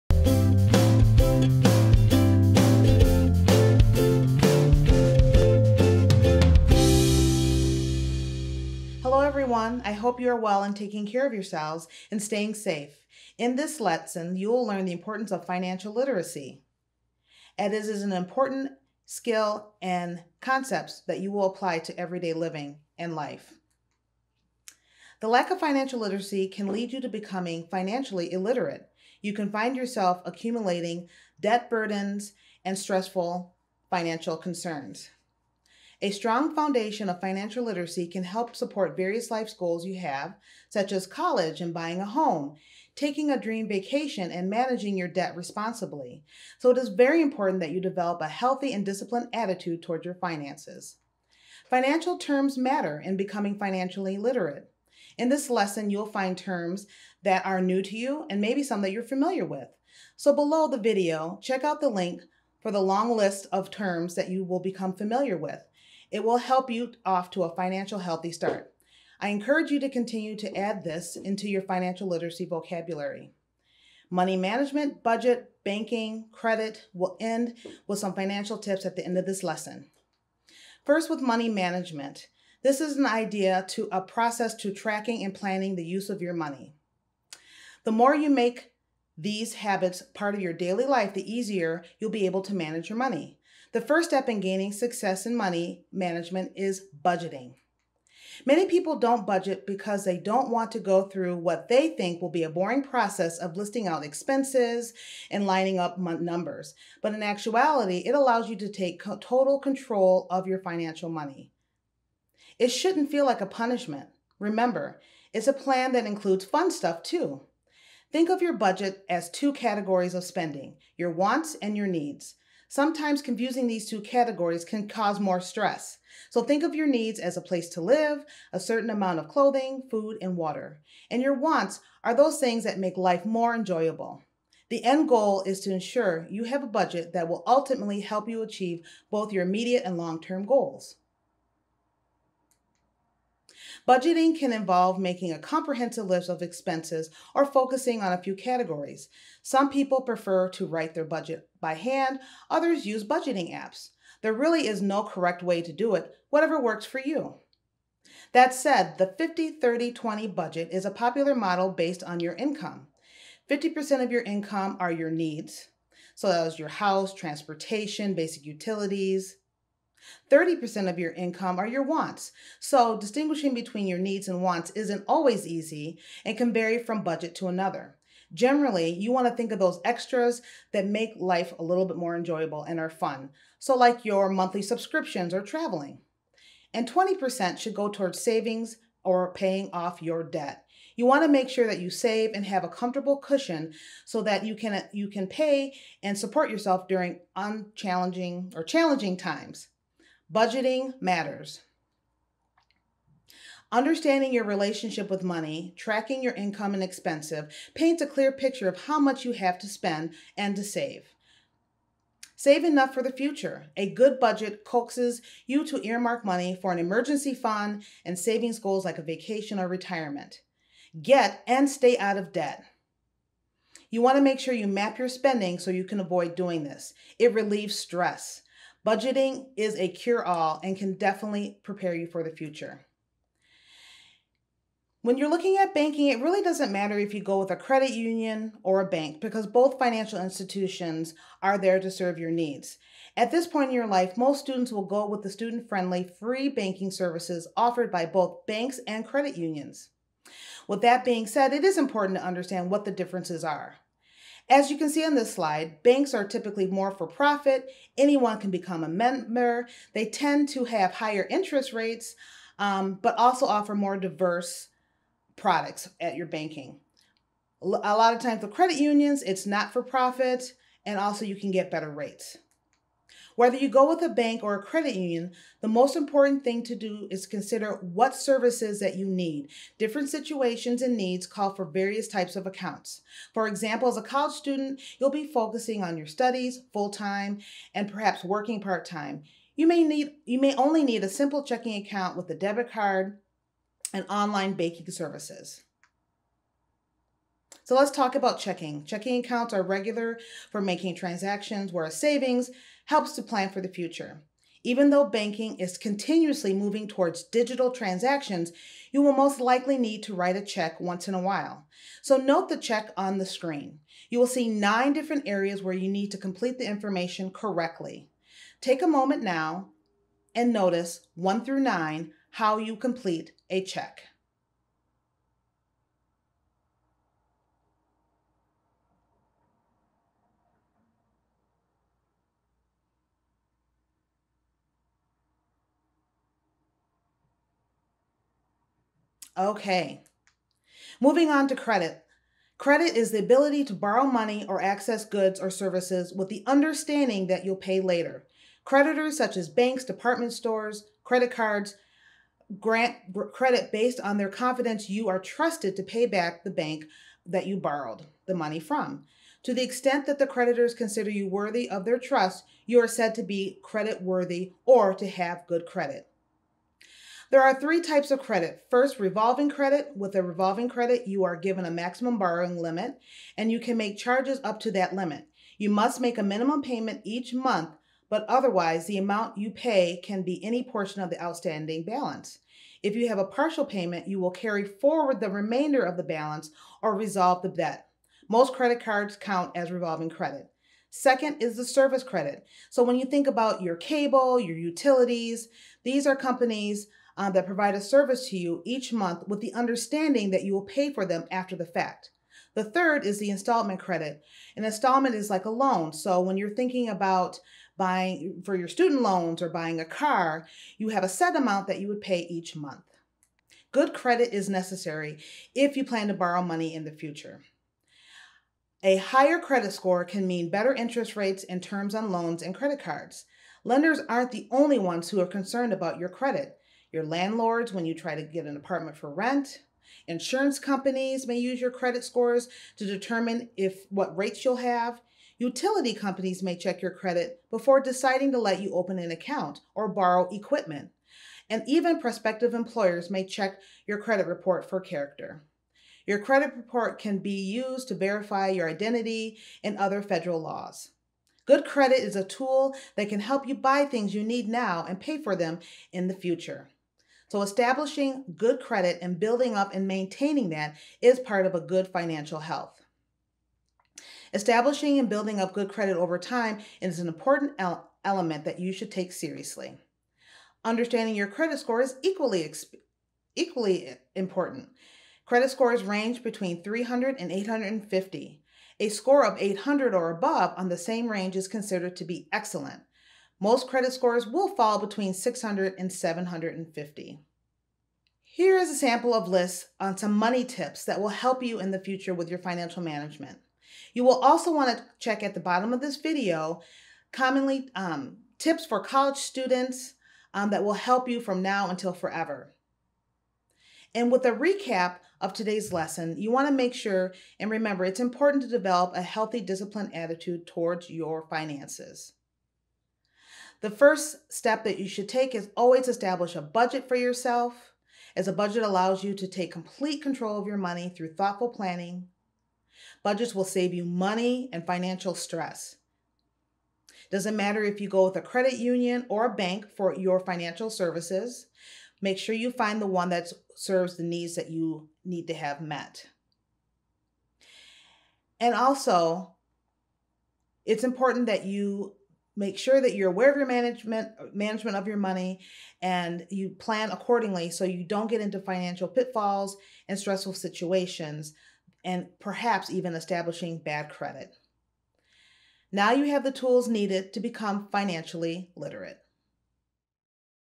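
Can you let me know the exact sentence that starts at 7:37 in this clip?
So establishing good credit and building up and maintaining that is part of a good financial health.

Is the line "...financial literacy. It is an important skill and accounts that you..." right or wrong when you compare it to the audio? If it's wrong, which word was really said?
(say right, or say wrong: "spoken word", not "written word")
wrong: "concepts", not "accounts".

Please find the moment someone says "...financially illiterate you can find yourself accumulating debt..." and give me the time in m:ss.
0:27.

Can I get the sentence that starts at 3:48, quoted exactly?
Budgeting is a cure all and can definitely prepare you for the future.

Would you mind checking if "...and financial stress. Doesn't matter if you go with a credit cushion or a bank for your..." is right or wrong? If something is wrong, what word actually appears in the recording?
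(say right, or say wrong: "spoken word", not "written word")
wrong: "union", not "cushion".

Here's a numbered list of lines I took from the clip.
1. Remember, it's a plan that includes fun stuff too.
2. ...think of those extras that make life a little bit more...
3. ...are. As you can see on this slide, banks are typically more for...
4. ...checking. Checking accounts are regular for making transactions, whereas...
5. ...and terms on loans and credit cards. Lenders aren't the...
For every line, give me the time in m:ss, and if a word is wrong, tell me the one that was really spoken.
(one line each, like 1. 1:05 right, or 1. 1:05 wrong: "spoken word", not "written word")
1. 1:54 right
2. 2:59 right
3. 4:13 right
4. 4:58 right
5. 7:01 right.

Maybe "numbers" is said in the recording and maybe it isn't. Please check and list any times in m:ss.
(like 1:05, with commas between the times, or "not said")
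1:45.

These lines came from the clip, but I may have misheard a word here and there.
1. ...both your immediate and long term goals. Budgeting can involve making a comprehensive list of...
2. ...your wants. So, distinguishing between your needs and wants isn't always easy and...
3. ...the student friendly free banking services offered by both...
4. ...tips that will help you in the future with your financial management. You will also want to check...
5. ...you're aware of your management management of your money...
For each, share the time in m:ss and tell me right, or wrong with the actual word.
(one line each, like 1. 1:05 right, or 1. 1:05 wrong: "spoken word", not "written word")
1. 2:19 right
2. 2:51 right
3. 4:05 right
4. 8:10 right
5. 9:02 right.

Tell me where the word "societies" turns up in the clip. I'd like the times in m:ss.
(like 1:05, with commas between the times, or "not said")
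not said.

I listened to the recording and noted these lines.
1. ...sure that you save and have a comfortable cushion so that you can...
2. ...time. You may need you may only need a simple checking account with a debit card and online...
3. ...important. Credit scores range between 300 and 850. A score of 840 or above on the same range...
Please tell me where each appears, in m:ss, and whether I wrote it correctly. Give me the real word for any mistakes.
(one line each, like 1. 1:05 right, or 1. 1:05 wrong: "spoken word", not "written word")
1. 3:11 right
2. 4:48 right
3. 7:54 wrong: "800", not "840".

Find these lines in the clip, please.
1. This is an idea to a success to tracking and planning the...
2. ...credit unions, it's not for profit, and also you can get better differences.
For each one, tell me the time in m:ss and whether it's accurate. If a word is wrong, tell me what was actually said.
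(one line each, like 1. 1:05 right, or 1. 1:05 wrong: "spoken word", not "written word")
1. 1:22 wrong: "process", not "success"
2. 4:28 wrong: "rates", not "differences".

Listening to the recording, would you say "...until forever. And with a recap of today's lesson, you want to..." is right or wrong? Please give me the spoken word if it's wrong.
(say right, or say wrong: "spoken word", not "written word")
right.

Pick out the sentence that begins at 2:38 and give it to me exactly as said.
That said, the 50 30 20 budget is a popular model based on your income.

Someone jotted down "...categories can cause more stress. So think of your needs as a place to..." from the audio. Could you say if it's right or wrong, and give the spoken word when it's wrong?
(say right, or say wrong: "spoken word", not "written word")
right.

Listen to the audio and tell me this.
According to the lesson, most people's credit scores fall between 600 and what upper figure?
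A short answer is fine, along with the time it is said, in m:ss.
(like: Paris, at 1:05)
750, at 8:05.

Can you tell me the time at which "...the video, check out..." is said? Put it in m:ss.
1:00.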